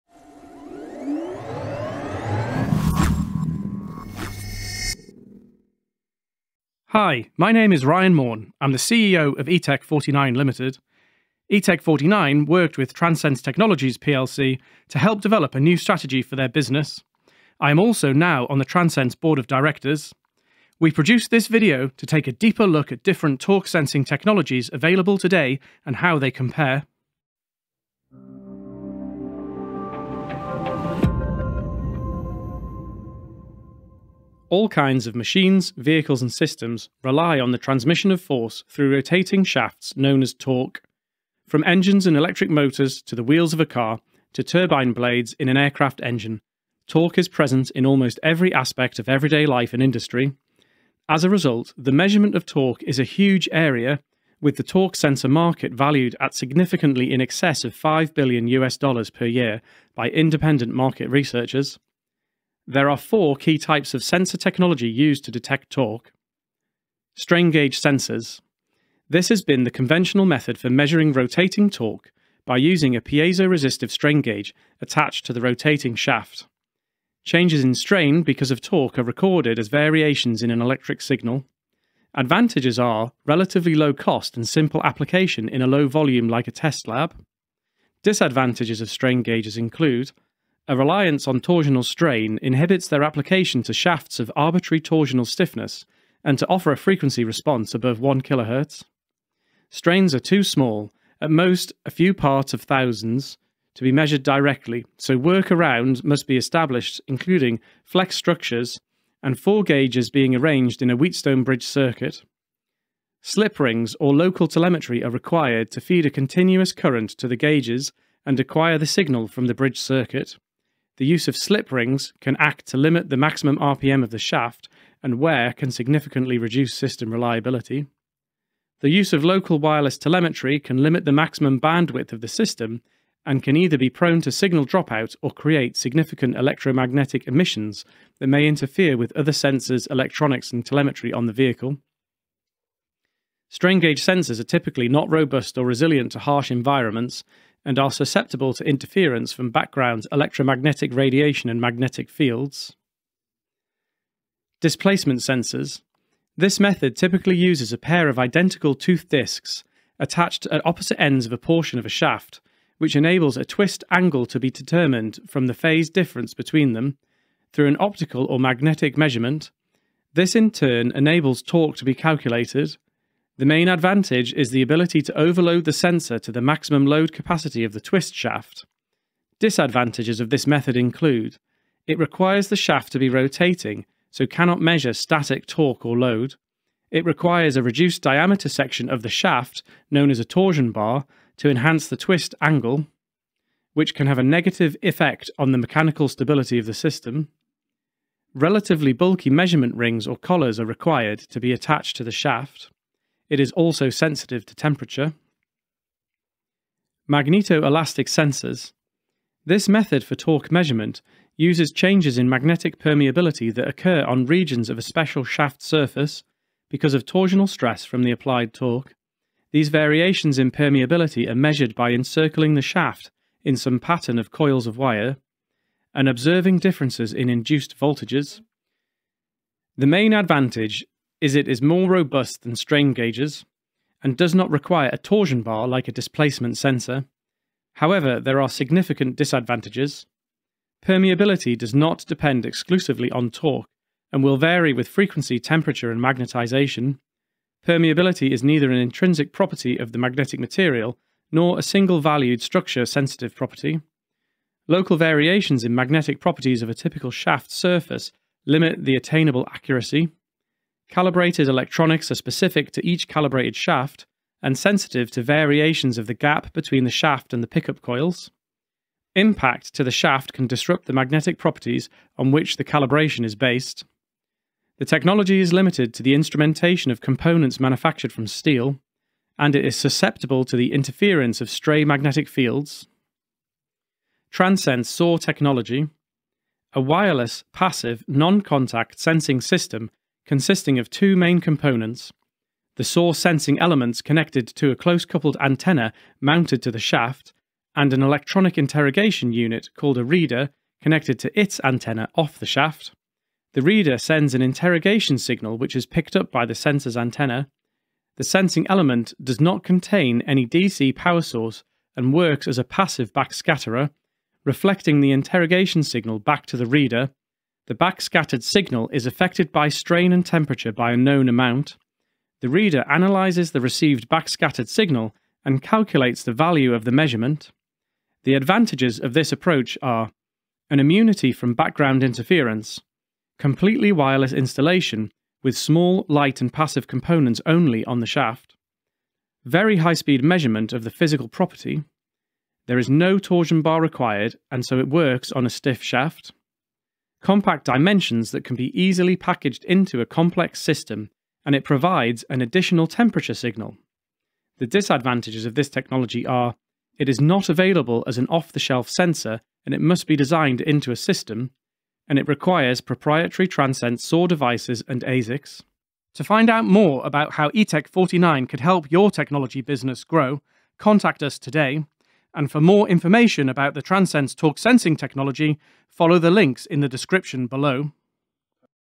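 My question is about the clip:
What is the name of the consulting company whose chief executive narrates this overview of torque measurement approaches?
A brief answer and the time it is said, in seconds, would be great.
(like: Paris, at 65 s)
eTech 49 Limited, at 9 s.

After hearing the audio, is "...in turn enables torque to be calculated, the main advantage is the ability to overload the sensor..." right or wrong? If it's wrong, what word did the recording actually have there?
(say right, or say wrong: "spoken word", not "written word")
right.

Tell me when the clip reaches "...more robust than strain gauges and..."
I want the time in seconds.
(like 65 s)
231 s.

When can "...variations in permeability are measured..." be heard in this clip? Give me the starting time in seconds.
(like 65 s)
219 s.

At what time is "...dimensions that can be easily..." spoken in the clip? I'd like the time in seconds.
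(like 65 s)
347 s.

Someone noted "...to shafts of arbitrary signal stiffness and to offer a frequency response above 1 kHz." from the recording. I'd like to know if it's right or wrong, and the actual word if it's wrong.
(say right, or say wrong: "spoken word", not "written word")
wrong: "torsional", not "signal".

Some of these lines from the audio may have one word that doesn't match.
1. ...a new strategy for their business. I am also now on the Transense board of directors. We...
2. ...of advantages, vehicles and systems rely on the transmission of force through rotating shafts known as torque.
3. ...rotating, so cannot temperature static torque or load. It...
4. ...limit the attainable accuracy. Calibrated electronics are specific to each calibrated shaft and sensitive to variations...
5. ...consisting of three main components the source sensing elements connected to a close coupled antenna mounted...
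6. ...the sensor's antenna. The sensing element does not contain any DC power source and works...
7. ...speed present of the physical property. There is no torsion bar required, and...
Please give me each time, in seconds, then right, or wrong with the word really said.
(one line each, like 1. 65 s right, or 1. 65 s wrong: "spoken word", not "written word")
1. 15 s right
2. 35 s wrong: "machines", not "advantages"
3. 183 s wrong: "measure", not "temperature"
4. 258 s right
5. 290 s wrong: "two", not "three"
6. 306 s right
7. 339 s wrong: "measurement", not "present".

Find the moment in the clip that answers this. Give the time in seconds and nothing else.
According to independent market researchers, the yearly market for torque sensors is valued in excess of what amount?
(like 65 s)
57 s.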